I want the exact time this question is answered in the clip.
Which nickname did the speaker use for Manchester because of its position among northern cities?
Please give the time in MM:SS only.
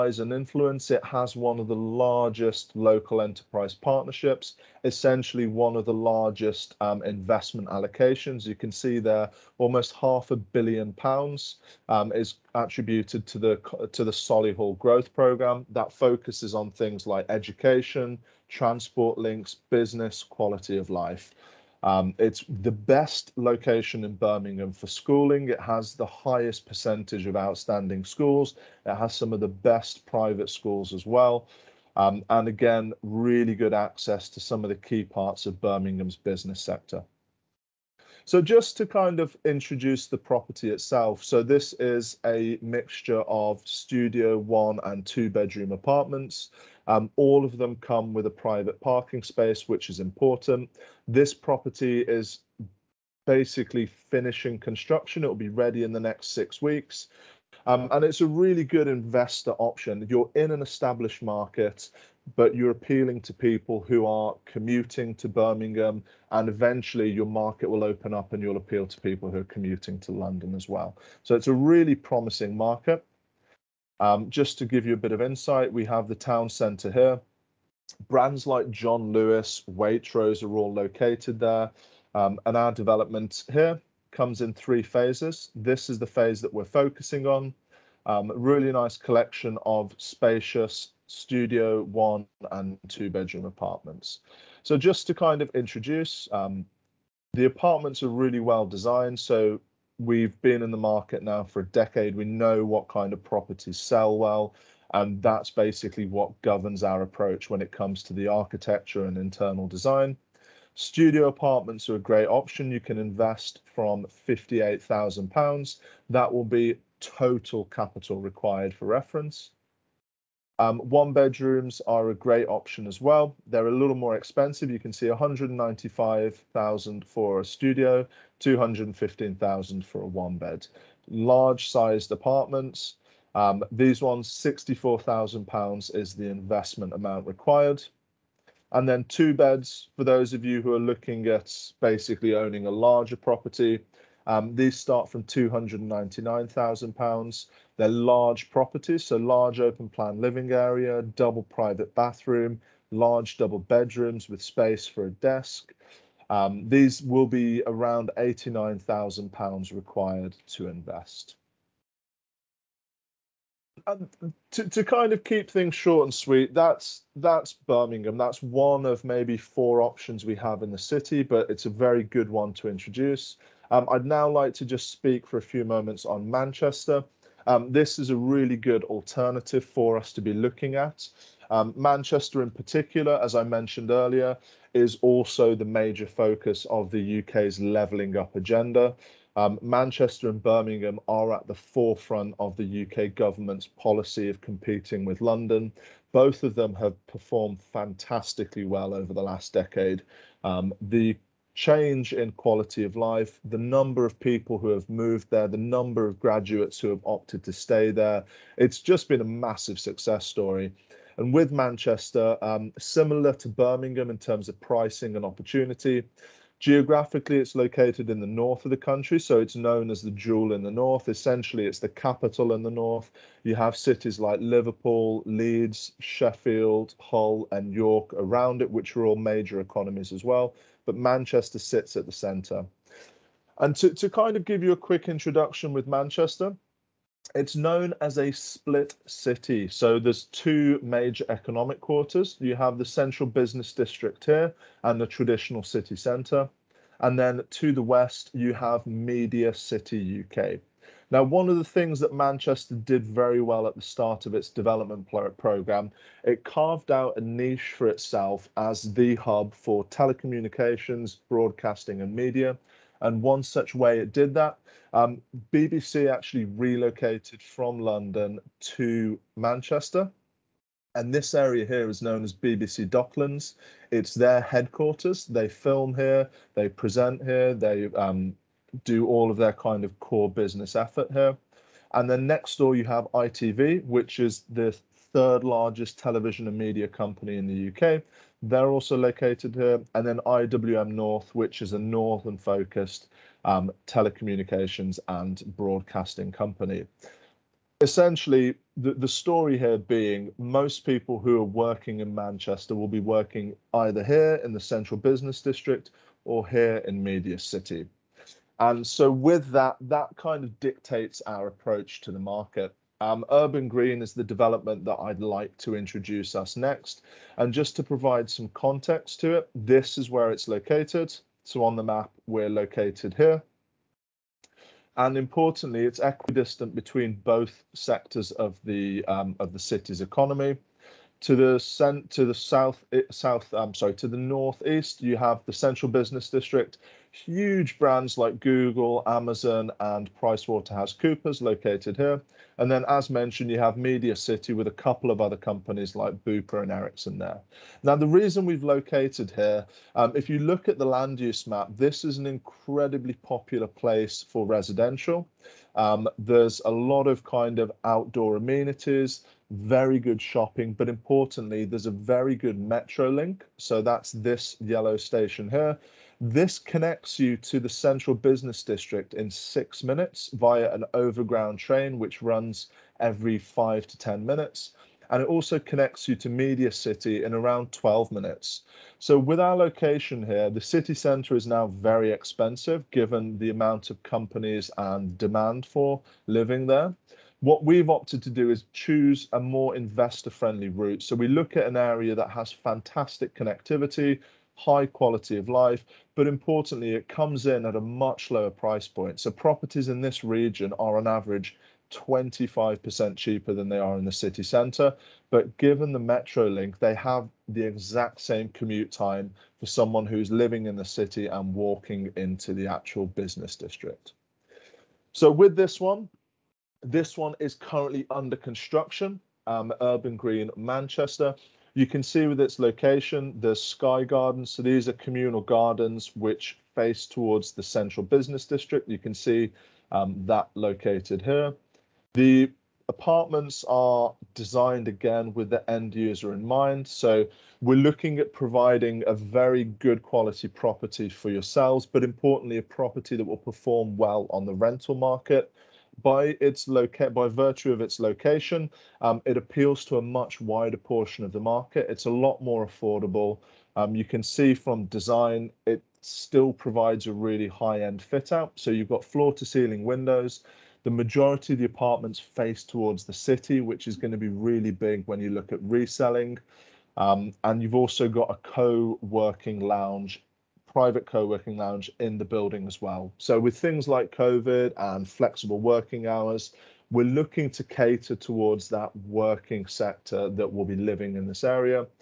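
03:40.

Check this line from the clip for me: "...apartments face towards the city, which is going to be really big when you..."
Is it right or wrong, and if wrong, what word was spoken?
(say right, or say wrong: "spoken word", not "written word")
right.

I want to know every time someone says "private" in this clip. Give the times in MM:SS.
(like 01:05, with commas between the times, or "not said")
00:30, 00:48, 02:31, 07:50.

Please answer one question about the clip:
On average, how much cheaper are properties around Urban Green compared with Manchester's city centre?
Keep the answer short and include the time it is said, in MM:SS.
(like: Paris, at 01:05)
25%, at 06:41.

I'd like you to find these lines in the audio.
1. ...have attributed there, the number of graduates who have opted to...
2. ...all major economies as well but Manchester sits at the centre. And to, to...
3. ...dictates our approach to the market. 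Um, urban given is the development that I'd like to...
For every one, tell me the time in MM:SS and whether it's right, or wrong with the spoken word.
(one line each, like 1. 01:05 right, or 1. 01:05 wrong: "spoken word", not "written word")
1. 03:24 wrong: "moved", not "attributed"
2. 03:49 right
3. 05:10 wrong: "green", not "given".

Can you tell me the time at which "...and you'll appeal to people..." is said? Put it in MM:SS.
01:08.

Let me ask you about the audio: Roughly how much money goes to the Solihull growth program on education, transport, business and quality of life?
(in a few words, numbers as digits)
Almost half a billion pounds.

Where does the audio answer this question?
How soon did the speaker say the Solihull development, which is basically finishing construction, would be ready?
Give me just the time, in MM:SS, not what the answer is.
00:56.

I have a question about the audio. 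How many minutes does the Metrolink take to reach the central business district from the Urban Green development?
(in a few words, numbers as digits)
6 minutes.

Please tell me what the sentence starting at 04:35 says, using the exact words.
They film here, they present here, they um, do all of their kind of core business effort here.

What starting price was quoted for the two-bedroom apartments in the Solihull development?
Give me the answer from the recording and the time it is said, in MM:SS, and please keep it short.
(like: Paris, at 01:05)
£299,000, at 02:25.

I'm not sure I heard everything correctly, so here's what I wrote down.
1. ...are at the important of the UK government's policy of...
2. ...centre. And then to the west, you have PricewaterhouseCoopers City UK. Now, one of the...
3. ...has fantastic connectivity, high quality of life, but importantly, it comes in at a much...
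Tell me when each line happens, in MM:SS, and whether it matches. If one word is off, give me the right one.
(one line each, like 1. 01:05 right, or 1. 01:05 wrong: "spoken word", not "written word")
1. 03:11 wrong: "forefront", not "important"
2. 04:05 wrong: "Media", not "PricewaterhouseCoopers"
3. 06:32 right.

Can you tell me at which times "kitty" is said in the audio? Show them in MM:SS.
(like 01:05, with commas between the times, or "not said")
not said.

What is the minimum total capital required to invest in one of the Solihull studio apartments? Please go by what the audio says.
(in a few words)
£58,000.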